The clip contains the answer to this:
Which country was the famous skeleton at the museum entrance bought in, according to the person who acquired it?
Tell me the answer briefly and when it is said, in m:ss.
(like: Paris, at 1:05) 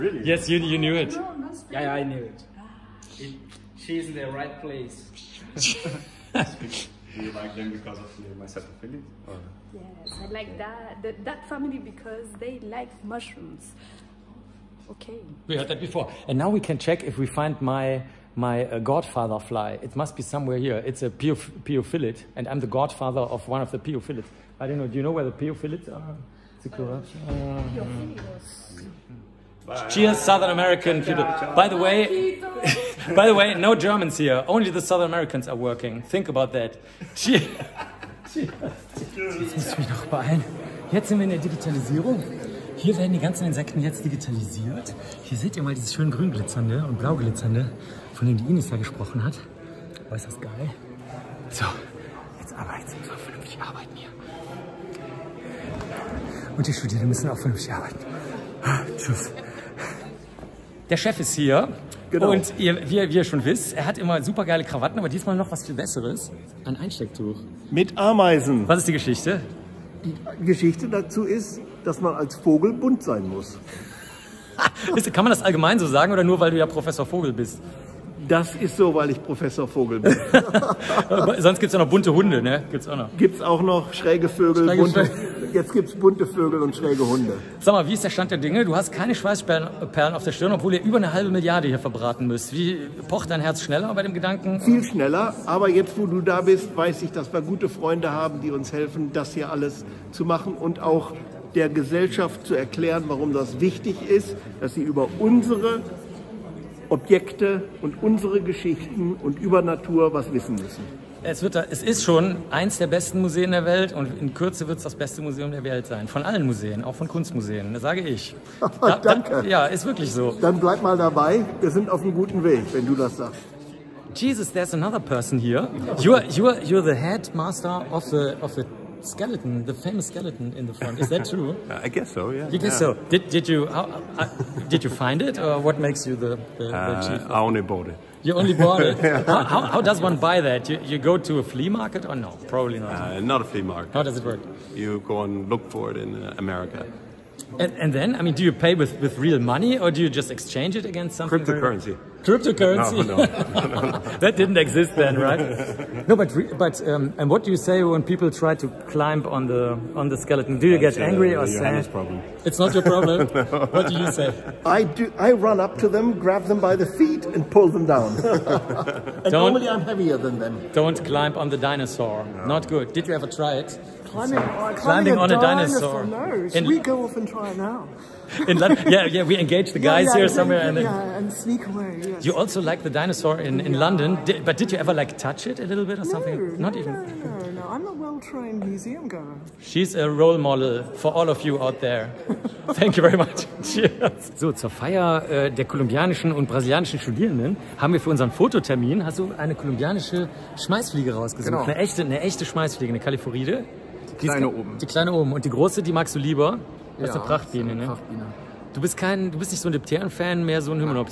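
America, at 2:26.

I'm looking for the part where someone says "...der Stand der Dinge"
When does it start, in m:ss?
1:28.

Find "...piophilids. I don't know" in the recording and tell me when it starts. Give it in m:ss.
0:23.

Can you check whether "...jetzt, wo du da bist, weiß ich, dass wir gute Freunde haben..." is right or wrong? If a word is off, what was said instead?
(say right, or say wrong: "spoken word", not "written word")
right.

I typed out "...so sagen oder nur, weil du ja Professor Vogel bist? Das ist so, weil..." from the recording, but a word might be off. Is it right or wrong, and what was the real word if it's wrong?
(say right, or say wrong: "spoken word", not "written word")
right.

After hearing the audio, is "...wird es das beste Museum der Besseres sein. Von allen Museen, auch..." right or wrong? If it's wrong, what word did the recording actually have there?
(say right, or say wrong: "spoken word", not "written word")
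wrong: "Welt", not "Besseres".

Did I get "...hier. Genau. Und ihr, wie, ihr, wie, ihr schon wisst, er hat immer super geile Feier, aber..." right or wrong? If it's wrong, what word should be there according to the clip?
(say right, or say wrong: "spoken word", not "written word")
wrong: "Krawatten", not "Feier".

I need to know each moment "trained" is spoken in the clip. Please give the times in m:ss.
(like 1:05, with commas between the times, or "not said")
3:07.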